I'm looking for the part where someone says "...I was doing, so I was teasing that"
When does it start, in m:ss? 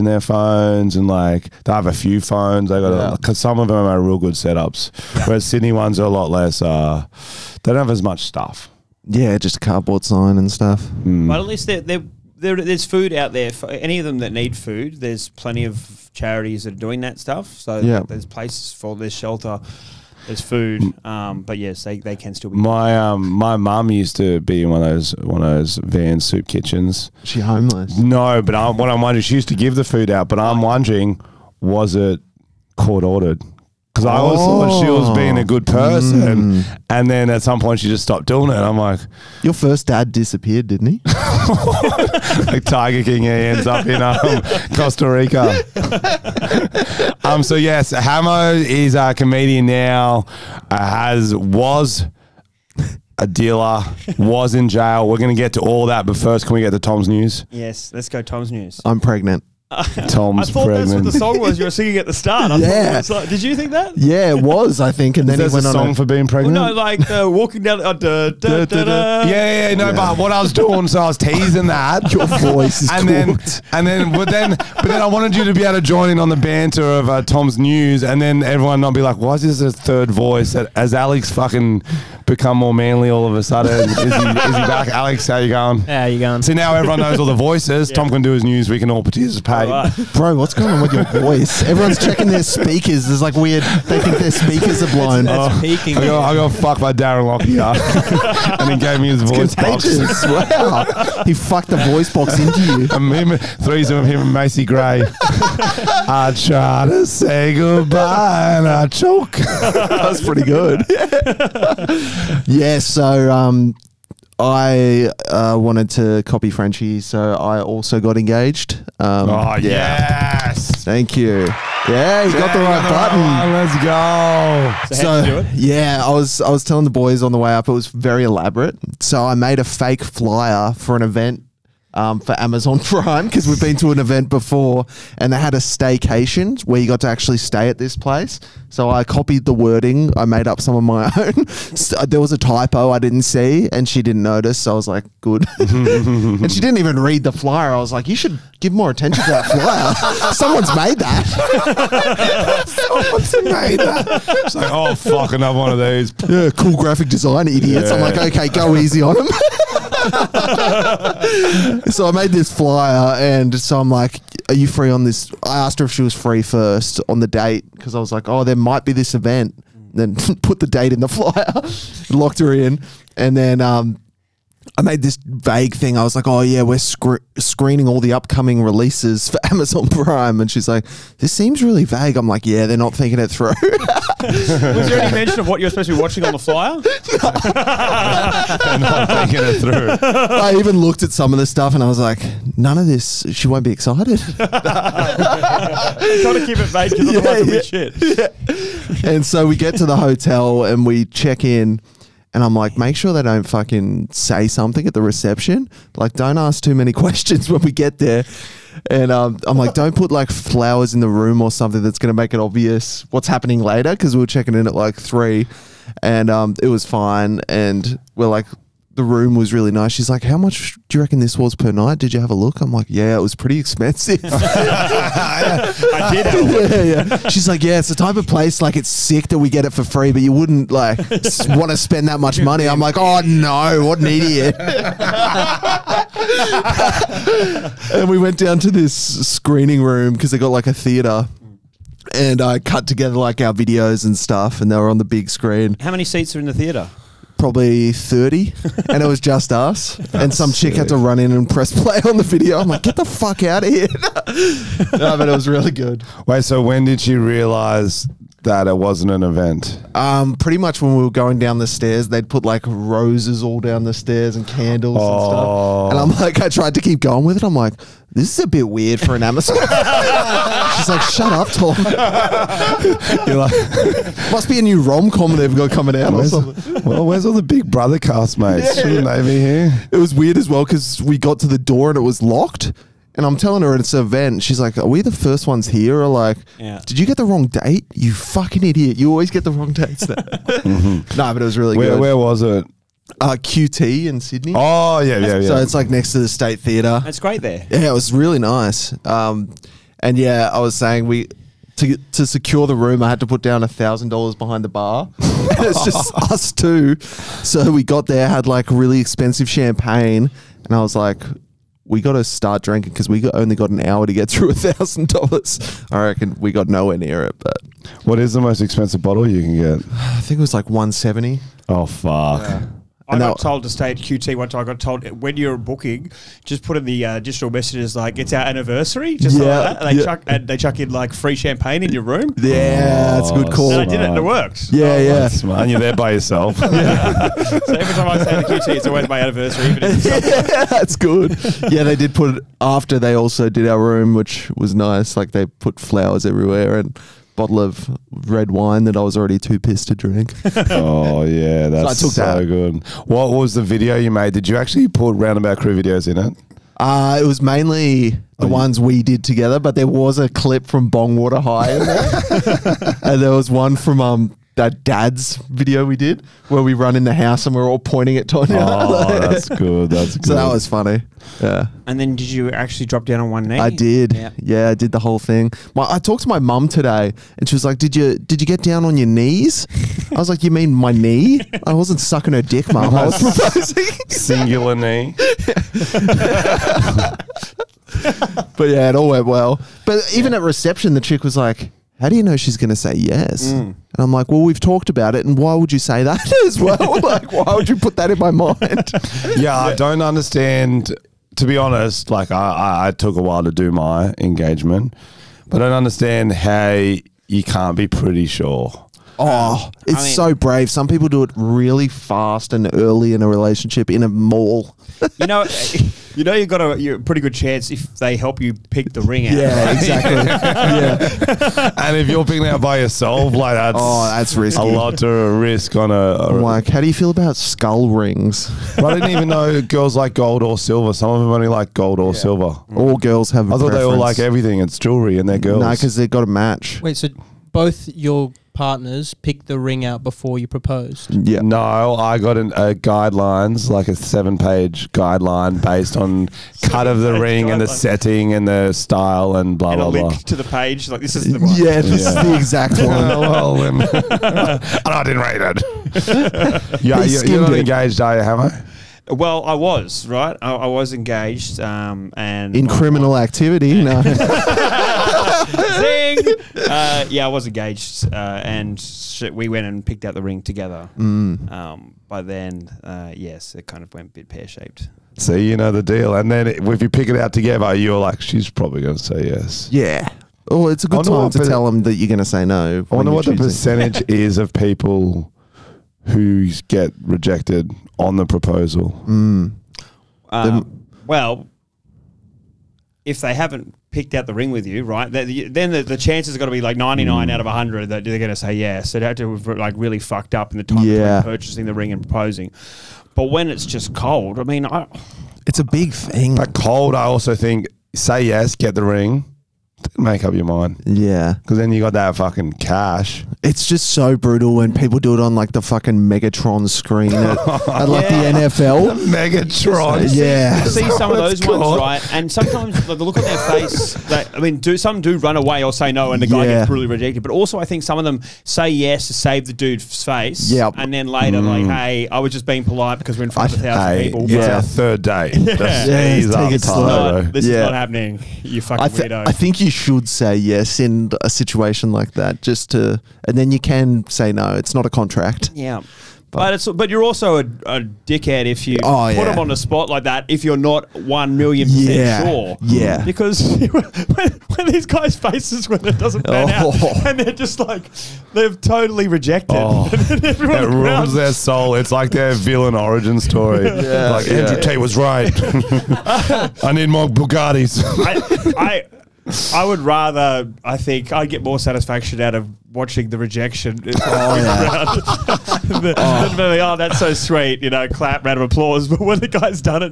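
1:10.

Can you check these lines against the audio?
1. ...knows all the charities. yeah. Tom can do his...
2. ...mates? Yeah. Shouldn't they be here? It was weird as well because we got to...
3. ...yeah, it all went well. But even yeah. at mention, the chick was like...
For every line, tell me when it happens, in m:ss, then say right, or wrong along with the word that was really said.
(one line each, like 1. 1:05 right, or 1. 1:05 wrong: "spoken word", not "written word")
1. 1:27 wrong: "voices", not "charities"
2. 4:38 right
3. 6:28 wrong: "reception", not "mention".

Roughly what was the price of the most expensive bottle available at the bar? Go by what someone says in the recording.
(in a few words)
170.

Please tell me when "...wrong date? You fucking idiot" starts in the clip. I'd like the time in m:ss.
4:47.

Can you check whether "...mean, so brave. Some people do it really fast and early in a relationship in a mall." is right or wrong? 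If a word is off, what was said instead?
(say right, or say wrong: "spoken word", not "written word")
right.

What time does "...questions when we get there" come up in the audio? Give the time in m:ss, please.
3:26.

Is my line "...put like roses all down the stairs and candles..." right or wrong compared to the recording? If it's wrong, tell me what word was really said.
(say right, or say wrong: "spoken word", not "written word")
right.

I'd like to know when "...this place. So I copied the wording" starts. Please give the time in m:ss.
2:17.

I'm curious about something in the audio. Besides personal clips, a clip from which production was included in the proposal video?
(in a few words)
Bongwater High.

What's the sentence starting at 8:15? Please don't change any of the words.
Then the, the chances are going to be like 99 mm.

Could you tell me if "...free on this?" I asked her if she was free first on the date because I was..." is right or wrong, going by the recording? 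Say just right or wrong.
right.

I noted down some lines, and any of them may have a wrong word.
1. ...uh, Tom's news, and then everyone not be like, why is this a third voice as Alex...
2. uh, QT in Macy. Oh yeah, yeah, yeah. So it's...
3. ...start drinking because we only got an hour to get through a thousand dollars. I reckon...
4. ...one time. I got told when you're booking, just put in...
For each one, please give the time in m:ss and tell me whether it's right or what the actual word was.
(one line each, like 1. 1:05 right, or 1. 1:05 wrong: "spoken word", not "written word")
1. 1:17 right
2. 4:53 wrong: "Sydney", not "Macy"
3. 5:12 right
4. 5:24 right.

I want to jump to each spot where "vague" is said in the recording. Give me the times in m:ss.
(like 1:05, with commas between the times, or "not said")
2:55, 3:01, 3:16.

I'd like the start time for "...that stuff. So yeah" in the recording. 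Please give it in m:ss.
0:17.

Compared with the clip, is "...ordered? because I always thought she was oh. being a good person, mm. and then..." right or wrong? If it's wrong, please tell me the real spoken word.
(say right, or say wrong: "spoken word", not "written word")
right.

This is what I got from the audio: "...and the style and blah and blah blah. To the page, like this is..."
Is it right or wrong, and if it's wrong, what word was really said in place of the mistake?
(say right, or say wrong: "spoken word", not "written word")
right.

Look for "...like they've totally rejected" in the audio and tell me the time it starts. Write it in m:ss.
9:17.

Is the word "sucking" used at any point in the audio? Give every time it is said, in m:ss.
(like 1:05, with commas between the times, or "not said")
6:22.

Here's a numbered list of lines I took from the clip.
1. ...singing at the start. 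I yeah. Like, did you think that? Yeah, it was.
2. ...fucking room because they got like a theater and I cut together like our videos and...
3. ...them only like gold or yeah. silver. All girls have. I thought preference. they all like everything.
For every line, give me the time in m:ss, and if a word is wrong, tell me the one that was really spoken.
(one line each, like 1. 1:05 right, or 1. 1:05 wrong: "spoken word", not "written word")
1. 1:01 right
2. 3:59 wrong: "screening", not "fucking"
3. 7:11 right.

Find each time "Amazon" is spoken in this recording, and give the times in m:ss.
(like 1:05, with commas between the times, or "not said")
2:12, 2:59, 4:29.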